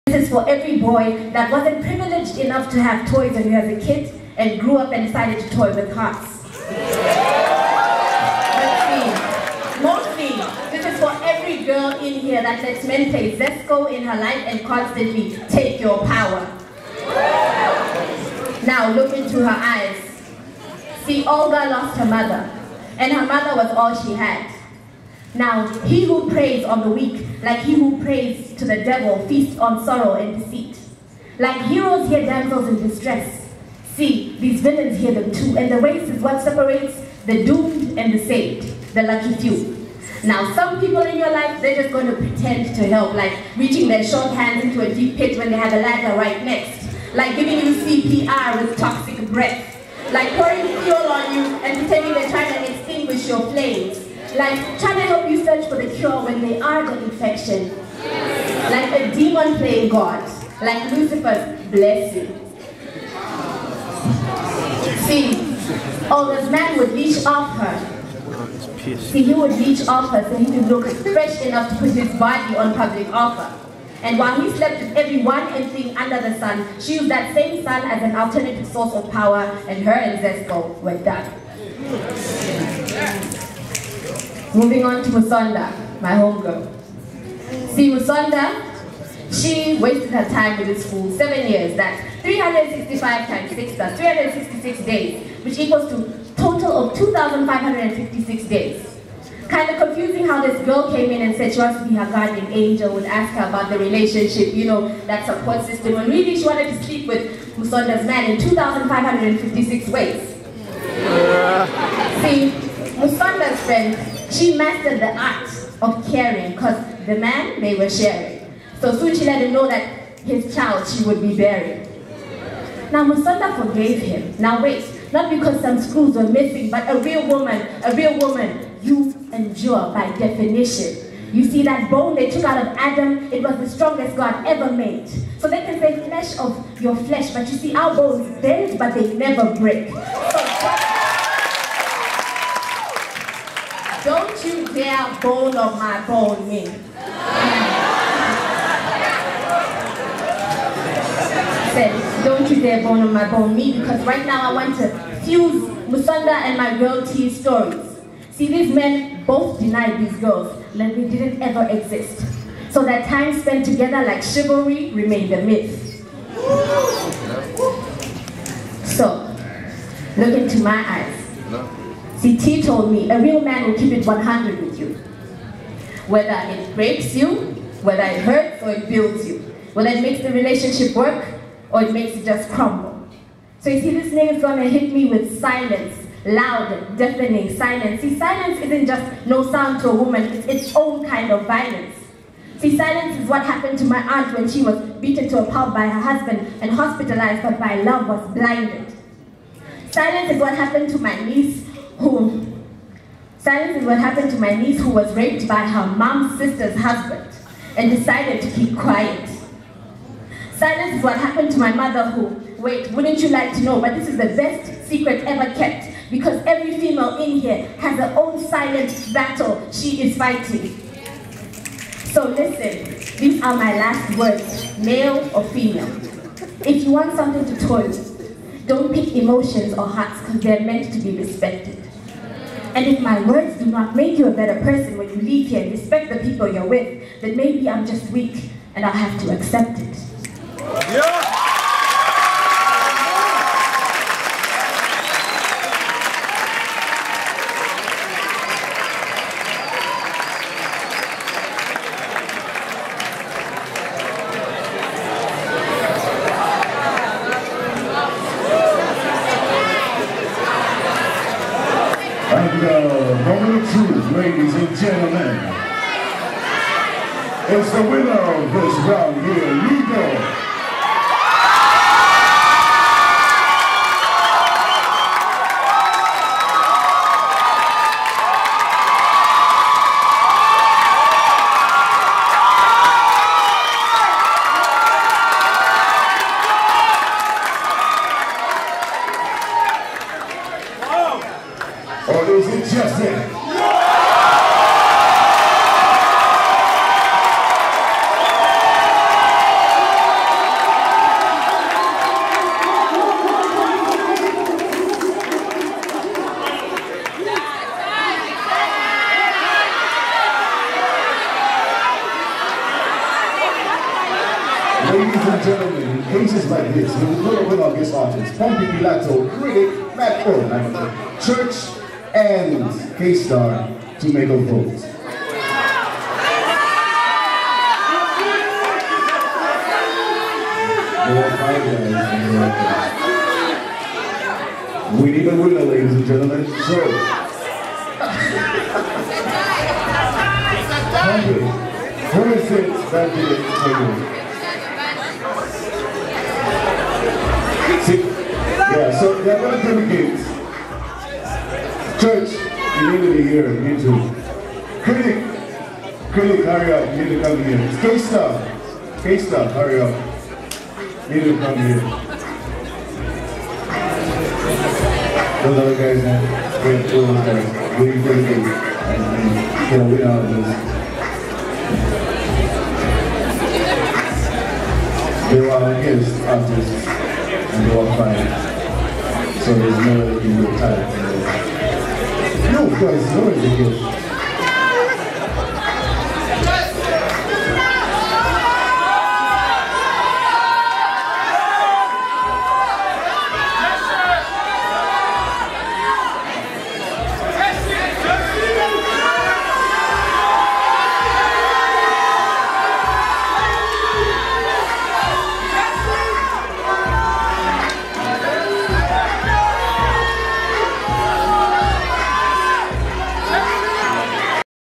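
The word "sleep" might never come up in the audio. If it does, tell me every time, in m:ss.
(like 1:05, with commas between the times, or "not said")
1:46.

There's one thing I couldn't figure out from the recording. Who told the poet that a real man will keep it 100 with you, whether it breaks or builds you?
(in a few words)
CT.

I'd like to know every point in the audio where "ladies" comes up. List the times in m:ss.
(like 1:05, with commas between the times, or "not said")
4:24, 5:15, 5:35.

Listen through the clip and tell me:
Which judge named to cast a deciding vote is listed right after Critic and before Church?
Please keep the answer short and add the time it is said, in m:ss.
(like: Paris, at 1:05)
Matt Owen, at 5:19.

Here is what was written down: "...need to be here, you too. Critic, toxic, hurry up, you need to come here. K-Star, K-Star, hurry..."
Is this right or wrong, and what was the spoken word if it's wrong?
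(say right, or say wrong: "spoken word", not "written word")
wrong: "critic", not "toxic".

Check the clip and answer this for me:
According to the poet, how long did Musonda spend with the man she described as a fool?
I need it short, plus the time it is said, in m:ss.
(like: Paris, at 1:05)
7 years, at 1:31.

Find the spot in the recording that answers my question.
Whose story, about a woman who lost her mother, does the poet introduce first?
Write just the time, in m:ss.
0:21.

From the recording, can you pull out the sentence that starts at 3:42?
So listen, these are my last words, male or female.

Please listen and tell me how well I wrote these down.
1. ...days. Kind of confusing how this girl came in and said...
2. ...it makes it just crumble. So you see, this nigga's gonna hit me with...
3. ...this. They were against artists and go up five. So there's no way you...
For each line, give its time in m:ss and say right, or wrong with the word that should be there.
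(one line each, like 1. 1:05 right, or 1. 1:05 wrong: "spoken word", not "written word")
1. 1:38 right
2. 3:01 right
3. 6:15 right.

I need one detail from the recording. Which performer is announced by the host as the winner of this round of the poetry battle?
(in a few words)
Nico.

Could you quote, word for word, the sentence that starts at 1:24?
Moving on to Musonda, my homegirl.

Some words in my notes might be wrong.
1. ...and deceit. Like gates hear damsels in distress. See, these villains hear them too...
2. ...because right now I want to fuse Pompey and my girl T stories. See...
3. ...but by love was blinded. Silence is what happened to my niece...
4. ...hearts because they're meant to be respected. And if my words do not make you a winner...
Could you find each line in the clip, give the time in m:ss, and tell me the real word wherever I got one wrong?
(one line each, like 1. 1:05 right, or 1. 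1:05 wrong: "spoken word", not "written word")
1. 0:30 wrong: "heroes", not "gates"
2. 2:33 wrong: "Musonda", not "Pompey"
3. 3:17 right
4. 3:49 wrong: "better", not "winner".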